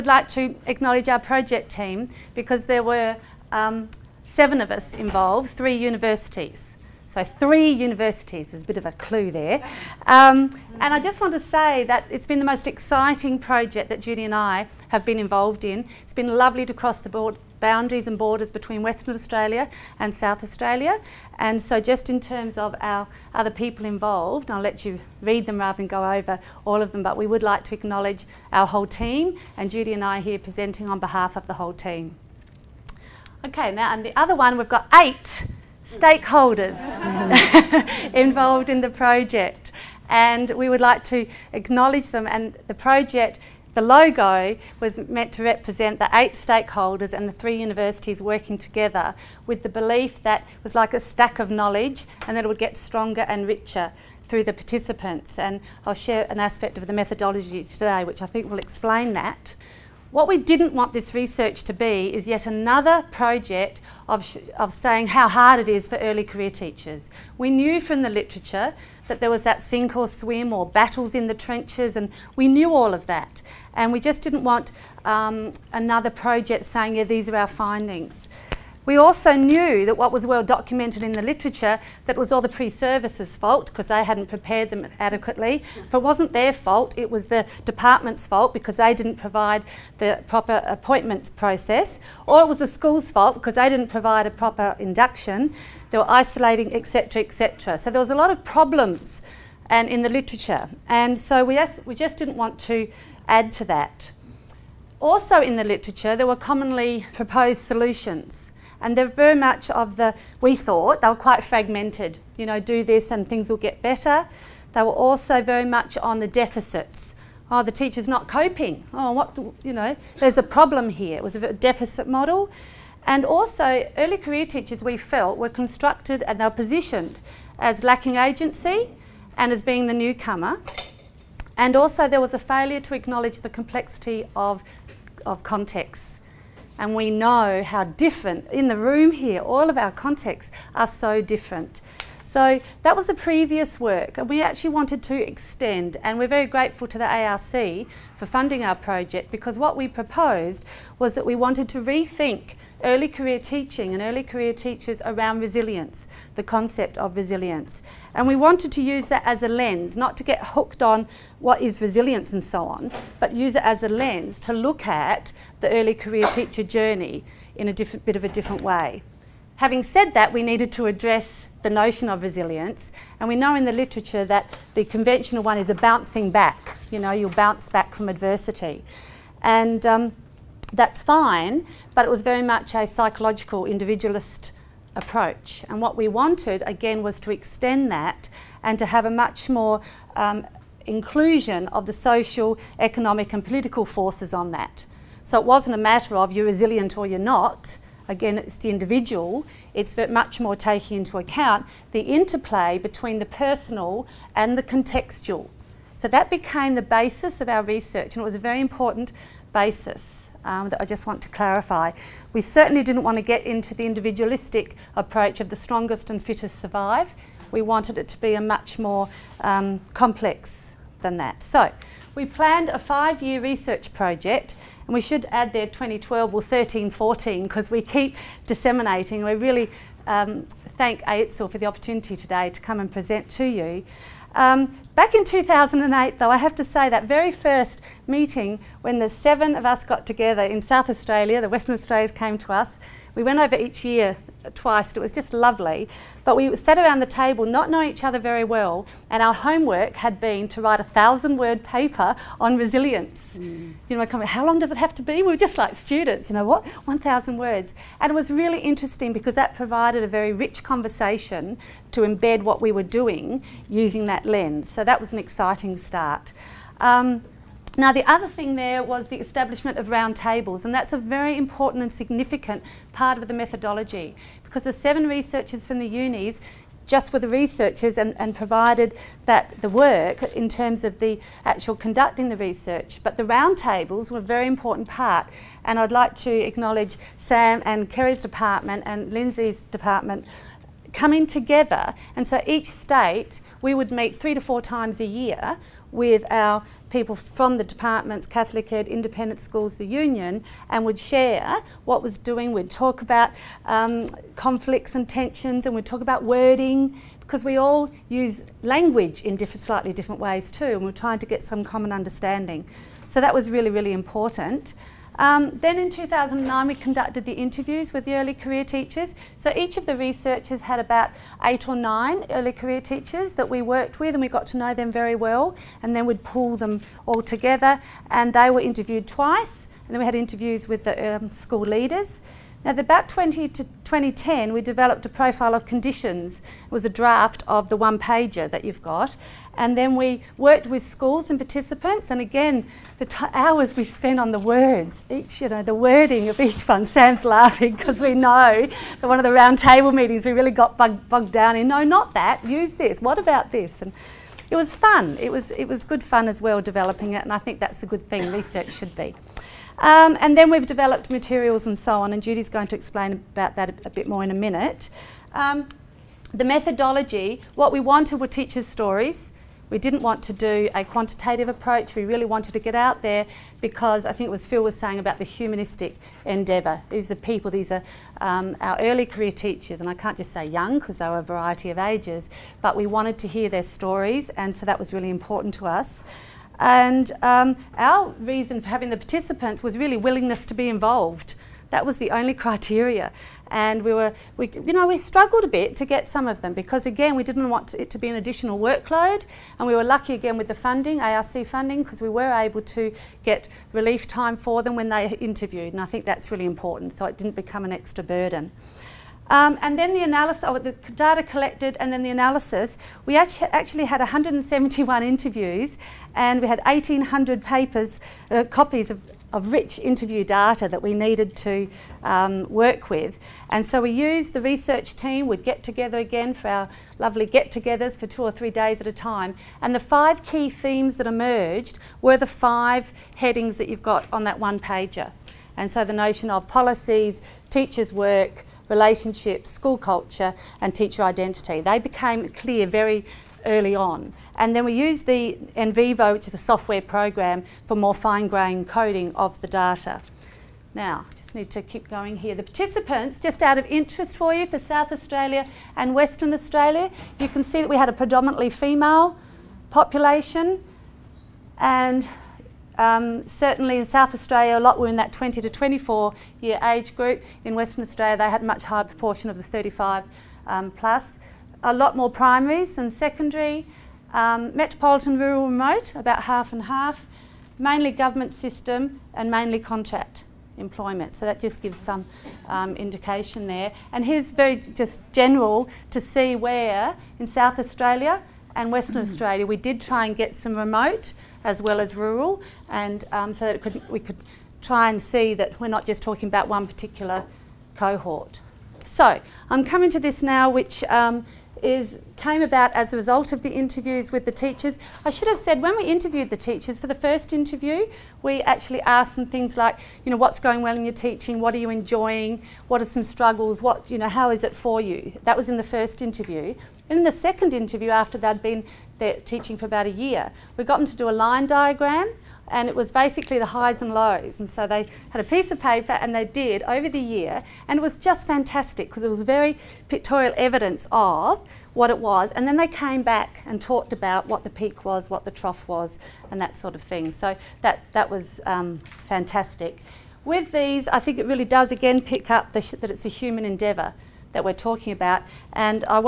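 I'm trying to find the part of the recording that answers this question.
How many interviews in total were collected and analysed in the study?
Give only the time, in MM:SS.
06:53.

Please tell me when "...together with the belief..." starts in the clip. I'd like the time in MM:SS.
00:48.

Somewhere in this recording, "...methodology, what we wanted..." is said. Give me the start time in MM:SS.
06:06.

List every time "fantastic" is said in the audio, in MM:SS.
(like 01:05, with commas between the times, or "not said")
08:48, 08:59.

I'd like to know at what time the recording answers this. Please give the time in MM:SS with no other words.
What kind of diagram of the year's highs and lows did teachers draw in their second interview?
08:41.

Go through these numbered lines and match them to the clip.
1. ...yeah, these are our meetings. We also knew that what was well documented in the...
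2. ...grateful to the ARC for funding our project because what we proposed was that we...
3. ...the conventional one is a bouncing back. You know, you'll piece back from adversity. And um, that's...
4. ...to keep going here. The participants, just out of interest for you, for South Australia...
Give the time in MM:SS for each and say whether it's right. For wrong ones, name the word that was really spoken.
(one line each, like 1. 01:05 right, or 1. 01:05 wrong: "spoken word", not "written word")
1. 01:16 wrong: "findings", not "meetings"
2. 02:26 right
3. 02:54 wrong: "bounce", not "piece"
4. 07:31 right.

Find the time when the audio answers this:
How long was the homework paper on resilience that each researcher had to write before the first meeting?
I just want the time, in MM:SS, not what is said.
04:10.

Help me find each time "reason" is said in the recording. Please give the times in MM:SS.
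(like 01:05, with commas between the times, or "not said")
06:28.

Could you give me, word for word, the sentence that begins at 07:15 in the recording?
And so the notion of policies, teachers' work, relationships, school culture, and teacher identity.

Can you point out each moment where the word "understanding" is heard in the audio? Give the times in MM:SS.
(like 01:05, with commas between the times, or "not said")
05:11.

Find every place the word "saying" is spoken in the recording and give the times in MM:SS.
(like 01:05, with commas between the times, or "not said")
01:04, 01:16, 06:14.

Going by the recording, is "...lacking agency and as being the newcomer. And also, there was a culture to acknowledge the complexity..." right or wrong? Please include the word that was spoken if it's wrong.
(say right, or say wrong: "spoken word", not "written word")
wrong: "failure", not "culture".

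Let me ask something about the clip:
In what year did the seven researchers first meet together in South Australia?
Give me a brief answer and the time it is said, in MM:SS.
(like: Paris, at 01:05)
2008, at 03:55.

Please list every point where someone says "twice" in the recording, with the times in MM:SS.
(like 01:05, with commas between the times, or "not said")
04:04, 05:29.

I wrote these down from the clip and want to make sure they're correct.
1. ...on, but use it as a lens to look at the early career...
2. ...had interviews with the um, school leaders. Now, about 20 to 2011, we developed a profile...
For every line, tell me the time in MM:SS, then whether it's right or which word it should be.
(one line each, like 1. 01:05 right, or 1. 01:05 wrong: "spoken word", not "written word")
1. 02:42 right
2. 05:30 wrong: "2010", not "2011".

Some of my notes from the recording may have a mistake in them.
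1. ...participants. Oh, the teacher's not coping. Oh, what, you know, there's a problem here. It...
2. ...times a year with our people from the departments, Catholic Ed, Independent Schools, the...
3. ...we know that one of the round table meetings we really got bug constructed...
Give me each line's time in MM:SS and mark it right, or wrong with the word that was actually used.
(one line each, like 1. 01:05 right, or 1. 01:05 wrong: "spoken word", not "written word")
1. 01:56 wrong: "deficits", not "participants"
2. 04:54 right
3. 05:47 wrong: "bogged", not "constructed".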